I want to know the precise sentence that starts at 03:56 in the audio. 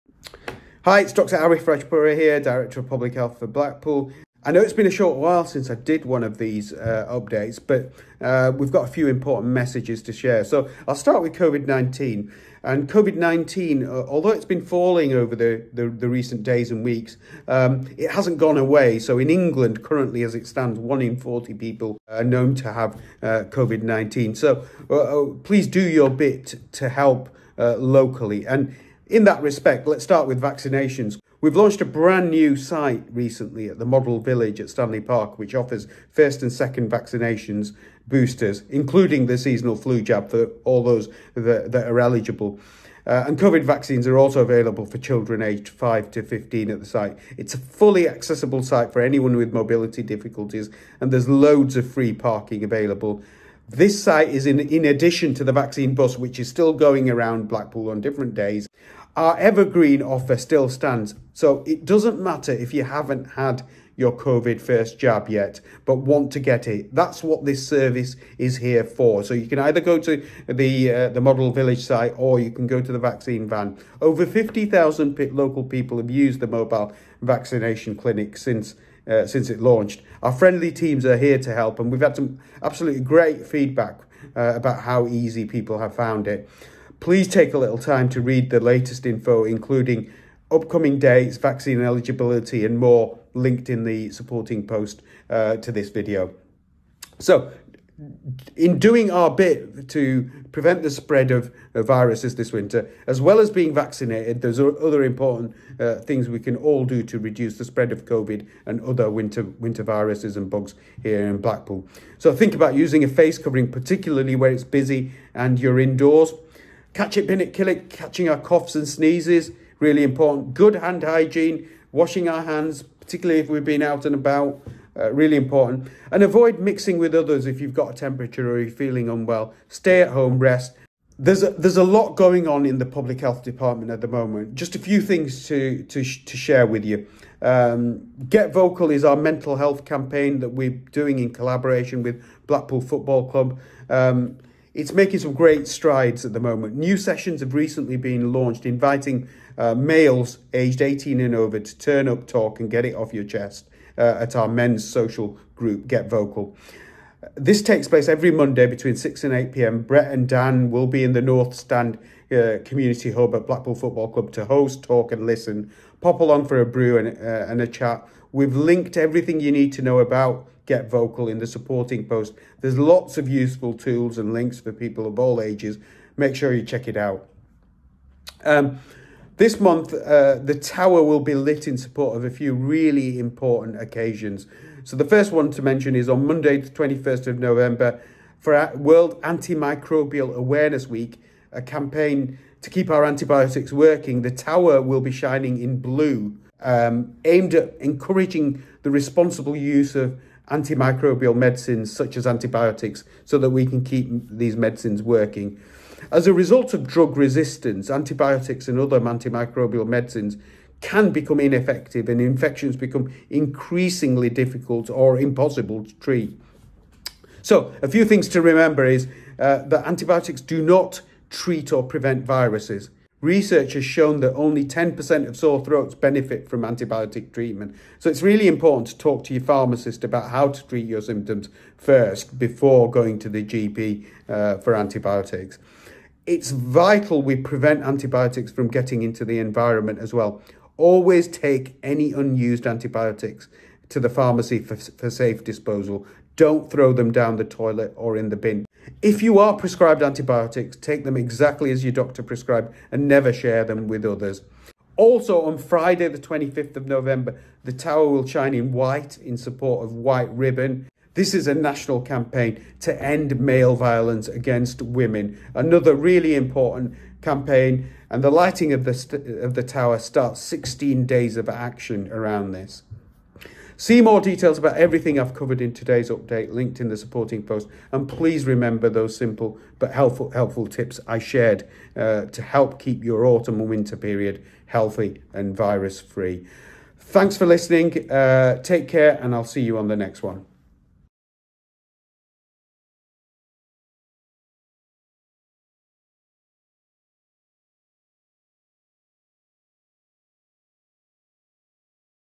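It's vital we prevent antibiotics from getting into the environment as well.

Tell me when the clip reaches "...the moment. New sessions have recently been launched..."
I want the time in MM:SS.
02:26.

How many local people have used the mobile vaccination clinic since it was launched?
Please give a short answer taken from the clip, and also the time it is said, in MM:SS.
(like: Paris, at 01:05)
Over 50,000, at 01:13.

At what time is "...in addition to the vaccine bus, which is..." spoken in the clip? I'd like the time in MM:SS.
00:54.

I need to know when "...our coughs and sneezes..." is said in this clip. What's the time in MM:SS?
01:58.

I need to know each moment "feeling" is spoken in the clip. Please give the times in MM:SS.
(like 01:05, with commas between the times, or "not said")
02:08.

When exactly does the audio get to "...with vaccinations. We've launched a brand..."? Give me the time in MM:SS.
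00:30.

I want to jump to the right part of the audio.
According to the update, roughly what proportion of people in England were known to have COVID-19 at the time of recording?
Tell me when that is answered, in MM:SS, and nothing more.
00:20.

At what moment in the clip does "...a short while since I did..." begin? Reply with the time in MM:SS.
00:04.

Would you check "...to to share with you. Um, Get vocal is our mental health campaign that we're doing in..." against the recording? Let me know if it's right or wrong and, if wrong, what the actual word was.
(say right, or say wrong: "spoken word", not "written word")
right.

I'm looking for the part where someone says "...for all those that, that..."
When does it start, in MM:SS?
00:40.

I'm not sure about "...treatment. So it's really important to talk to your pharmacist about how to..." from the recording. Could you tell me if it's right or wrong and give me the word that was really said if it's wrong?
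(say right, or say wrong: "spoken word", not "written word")
right.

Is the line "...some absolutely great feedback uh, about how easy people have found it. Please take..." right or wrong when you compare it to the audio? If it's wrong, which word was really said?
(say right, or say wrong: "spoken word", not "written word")
right.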